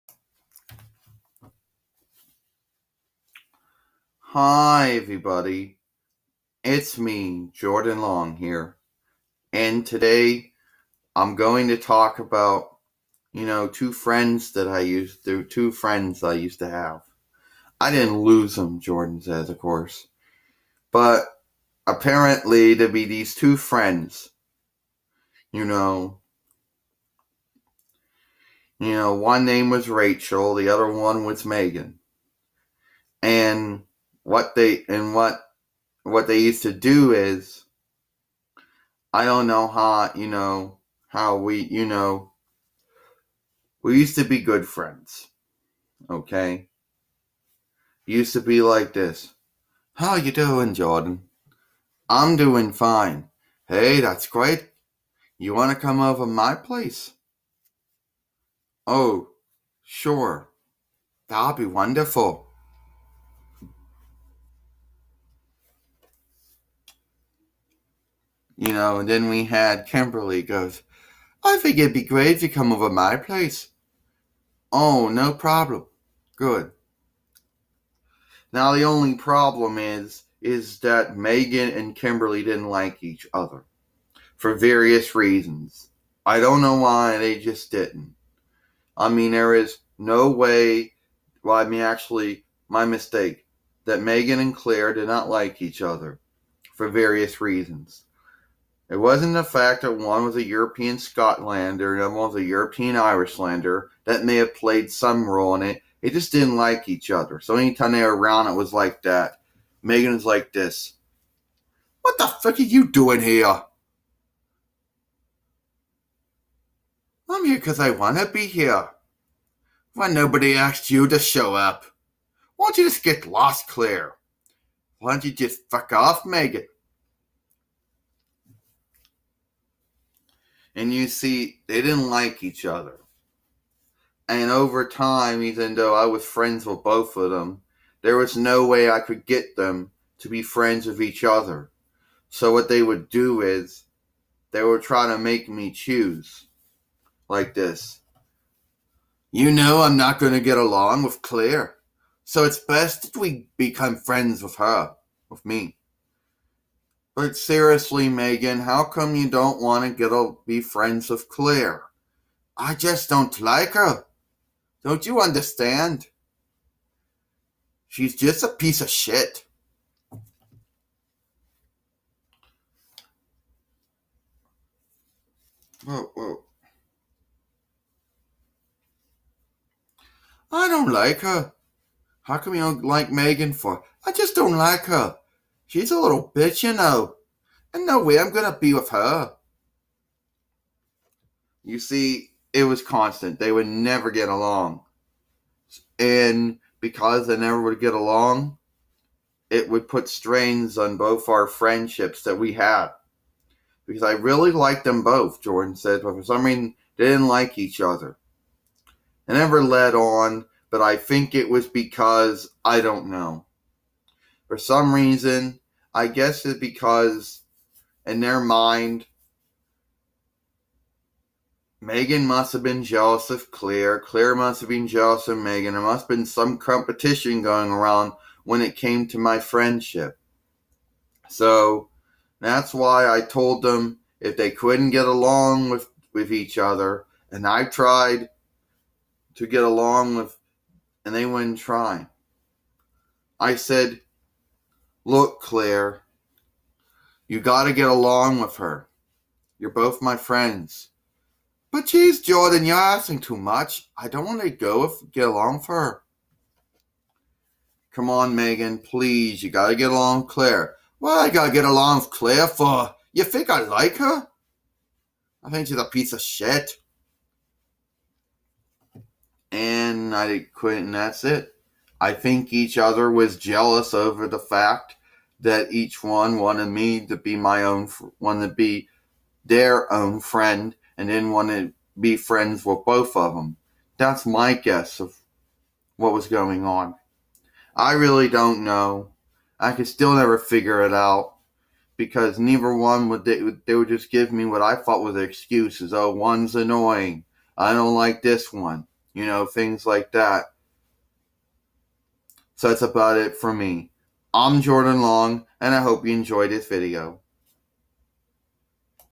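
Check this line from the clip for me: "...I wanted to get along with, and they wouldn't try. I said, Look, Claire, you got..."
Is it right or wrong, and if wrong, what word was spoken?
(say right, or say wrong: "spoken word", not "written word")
wrong: "tried", not "wanted".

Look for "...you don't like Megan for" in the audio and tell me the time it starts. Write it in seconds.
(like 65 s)
182 s.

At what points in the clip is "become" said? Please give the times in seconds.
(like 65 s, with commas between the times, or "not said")
153 s.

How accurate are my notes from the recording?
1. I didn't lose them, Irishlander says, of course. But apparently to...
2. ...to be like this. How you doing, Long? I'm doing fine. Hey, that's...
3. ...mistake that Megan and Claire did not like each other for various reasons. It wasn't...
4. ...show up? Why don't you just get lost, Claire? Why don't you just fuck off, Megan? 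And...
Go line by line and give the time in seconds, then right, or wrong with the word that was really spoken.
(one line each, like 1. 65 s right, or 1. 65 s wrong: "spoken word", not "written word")
1. 17 s wrong: "Jordan", not "Irishlander"
2. 48 s wrong: "Jordan", not "Long"
3. 92 s right
4. 121 s right.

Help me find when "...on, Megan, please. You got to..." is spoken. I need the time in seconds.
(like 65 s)
258 s.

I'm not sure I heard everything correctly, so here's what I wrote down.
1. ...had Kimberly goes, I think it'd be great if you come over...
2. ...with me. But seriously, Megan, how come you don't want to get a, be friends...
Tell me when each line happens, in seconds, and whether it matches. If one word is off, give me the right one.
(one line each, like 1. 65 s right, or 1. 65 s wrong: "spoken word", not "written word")
1. 69 s right
2. 155 s right.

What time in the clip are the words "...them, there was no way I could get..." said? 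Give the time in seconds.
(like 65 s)
137 s.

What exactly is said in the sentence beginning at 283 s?
That's my guess of what was going on.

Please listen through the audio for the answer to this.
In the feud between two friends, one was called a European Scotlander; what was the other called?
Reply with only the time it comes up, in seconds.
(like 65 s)
102 s.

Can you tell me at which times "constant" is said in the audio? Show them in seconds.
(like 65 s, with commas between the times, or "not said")
192 s.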